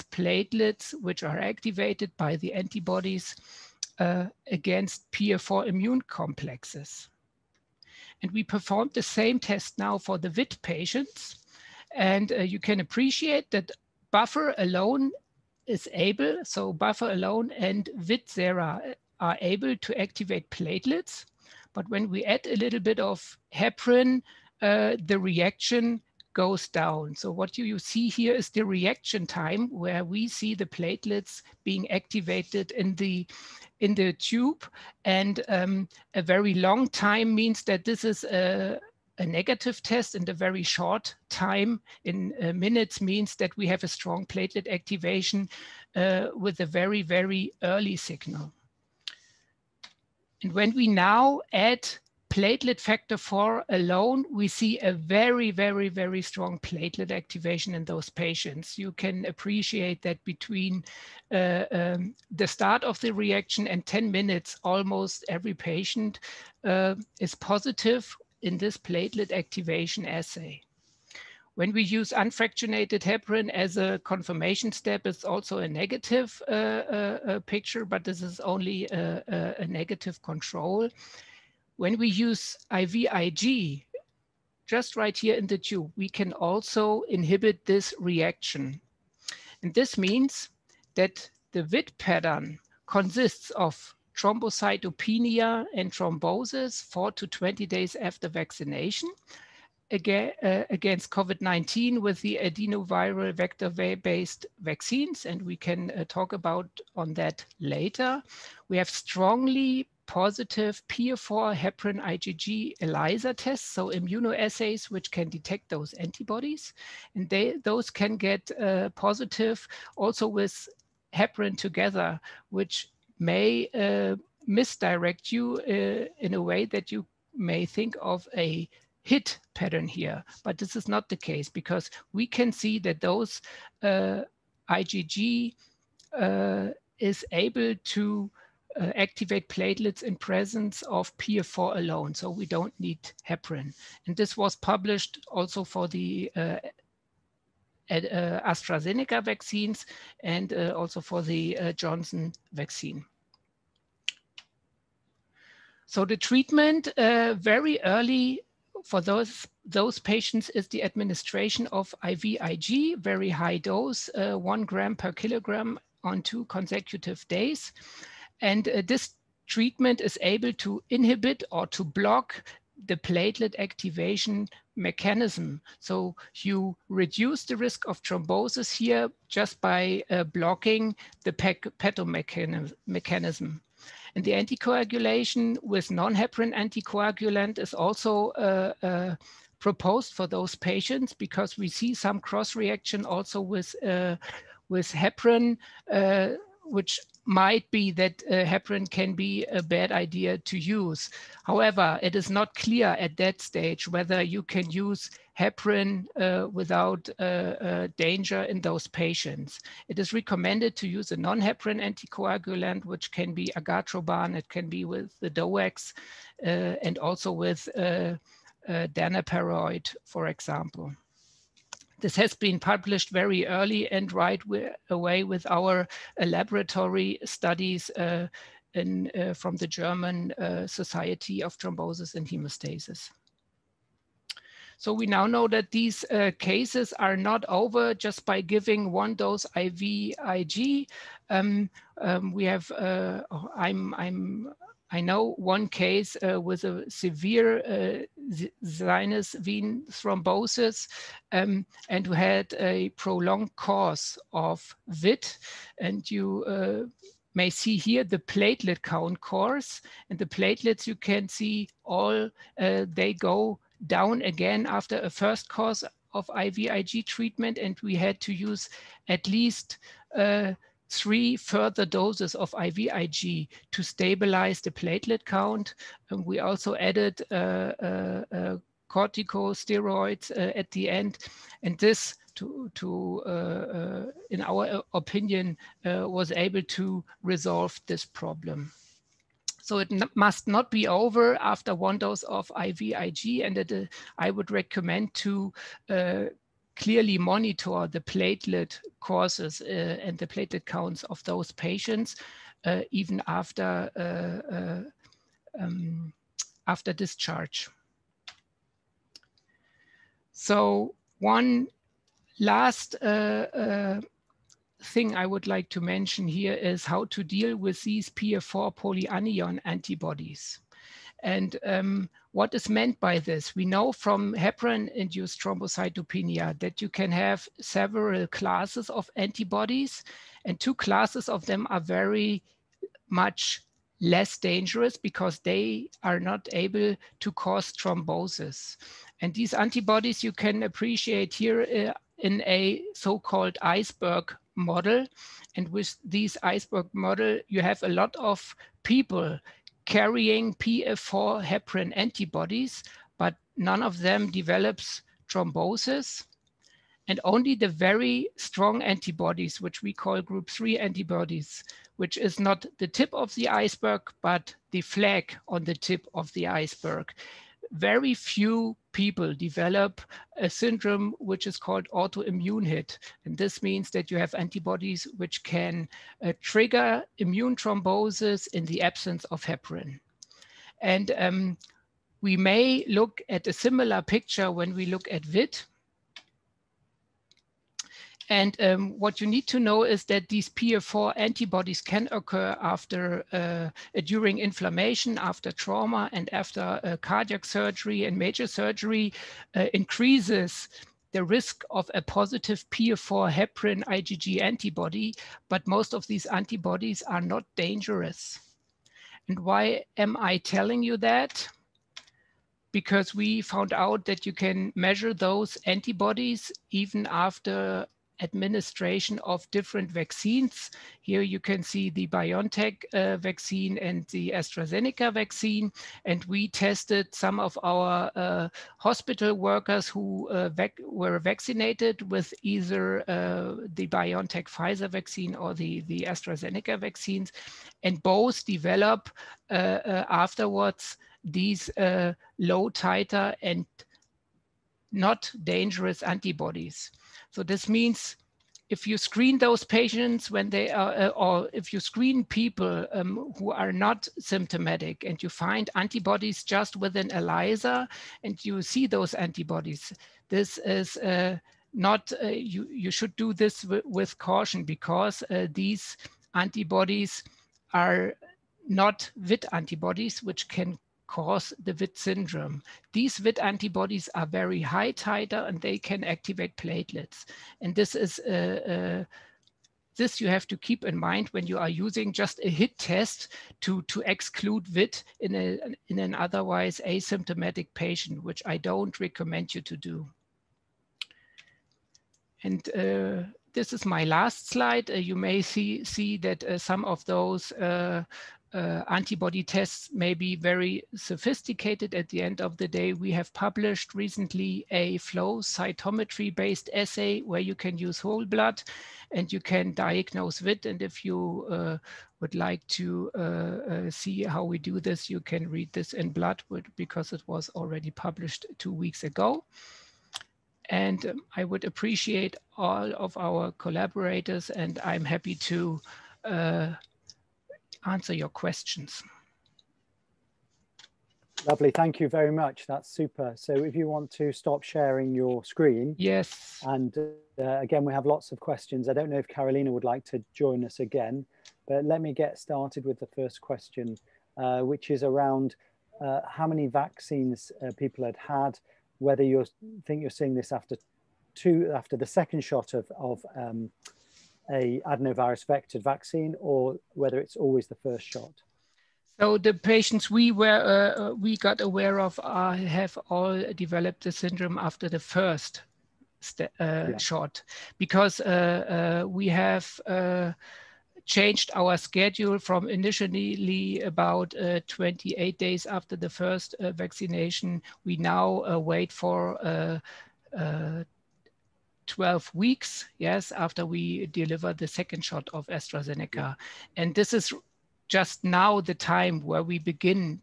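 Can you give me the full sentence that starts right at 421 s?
Here you can see the BioNTech uh, vaccine and the AstraZeneca vaccine.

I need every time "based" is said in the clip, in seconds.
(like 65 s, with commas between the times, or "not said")
103 s, 506 s.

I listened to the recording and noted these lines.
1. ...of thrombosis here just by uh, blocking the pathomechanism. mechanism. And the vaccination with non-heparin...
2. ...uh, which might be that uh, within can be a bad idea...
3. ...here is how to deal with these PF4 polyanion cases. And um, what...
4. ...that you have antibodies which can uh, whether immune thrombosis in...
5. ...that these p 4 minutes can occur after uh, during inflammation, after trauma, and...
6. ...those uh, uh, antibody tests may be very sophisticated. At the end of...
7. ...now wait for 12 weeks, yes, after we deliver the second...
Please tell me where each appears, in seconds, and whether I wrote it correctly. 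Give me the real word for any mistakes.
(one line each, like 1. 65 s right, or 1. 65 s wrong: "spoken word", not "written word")
1. 177 s wrong: "anticoagulation", not "vaccination"
2. 195 s wrong: "heparin", not "within"
3. 316 s wrong: "antibodies", not "cases"
4. 373 s wrong: "trigger", not "whether"
5. 390 s wrong: "antibodies", not "minutes"
6. 497 s right
7. 577 s right.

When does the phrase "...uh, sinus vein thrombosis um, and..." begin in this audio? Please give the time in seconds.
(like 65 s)
247 s.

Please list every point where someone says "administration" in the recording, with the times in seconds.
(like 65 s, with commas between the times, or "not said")
160 s, 418 s.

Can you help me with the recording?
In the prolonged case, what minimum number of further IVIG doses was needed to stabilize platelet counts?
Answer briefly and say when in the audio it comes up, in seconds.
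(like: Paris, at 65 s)
3, at 270 s.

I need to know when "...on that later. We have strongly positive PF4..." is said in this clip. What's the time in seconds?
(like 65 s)
106 s.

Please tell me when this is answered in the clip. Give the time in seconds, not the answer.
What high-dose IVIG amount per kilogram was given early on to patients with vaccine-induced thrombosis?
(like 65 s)
164 s.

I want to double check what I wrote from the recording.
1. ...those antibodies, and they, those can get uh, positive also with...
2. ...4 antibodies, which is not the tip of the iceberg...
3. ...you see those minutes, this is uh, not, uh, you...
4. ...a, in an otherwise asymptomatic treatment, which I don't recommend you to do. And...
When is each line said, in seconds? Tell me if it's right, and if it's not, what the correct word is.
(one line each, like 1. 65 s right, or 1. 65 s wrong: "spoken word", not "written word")
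1. 115 s right
2. 360 s wrong: "3", not "4"
3. 458 s wrong: "antibodies", not "minutes"
4. 485 s wrong: "patient", not "treatment".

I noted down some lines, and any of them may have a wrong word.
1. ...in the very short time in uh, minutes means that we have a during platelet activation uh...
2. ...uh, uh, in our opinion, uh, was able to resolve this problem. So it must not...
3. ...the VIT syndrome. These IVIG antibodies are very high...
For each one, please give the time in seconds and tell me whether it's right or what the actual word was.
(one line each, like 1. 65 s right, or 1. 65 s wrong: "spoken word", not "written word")
1. 40 s wrong: "strong", not "during"
2. 283 s right
3. 471 s wrong: "VIT", not "IVIG".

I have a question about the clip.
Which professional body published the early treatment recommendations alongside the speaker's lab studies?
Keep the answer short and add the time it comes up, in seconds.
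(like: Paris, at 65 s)
German Society of Thrombosis and Hemostasis, at 229 s.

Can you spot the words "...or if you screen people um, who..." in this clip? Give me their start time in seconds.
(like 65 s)
451 s.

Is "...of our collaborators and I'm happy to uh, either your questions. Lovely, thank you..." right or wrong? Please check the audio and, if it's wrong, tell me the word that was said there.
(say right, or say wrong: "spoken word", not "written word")
wrong: "answer", not "either".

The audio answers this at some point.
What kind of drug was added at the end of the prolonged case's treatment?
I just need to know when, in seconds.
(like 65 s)
278 s.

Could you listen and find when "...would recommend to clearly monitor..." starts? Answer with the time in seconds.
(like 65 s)
294 s.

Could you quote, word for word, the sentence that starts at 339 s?
And these antibodies you can appreciate here uh, in a so-called iceberg model.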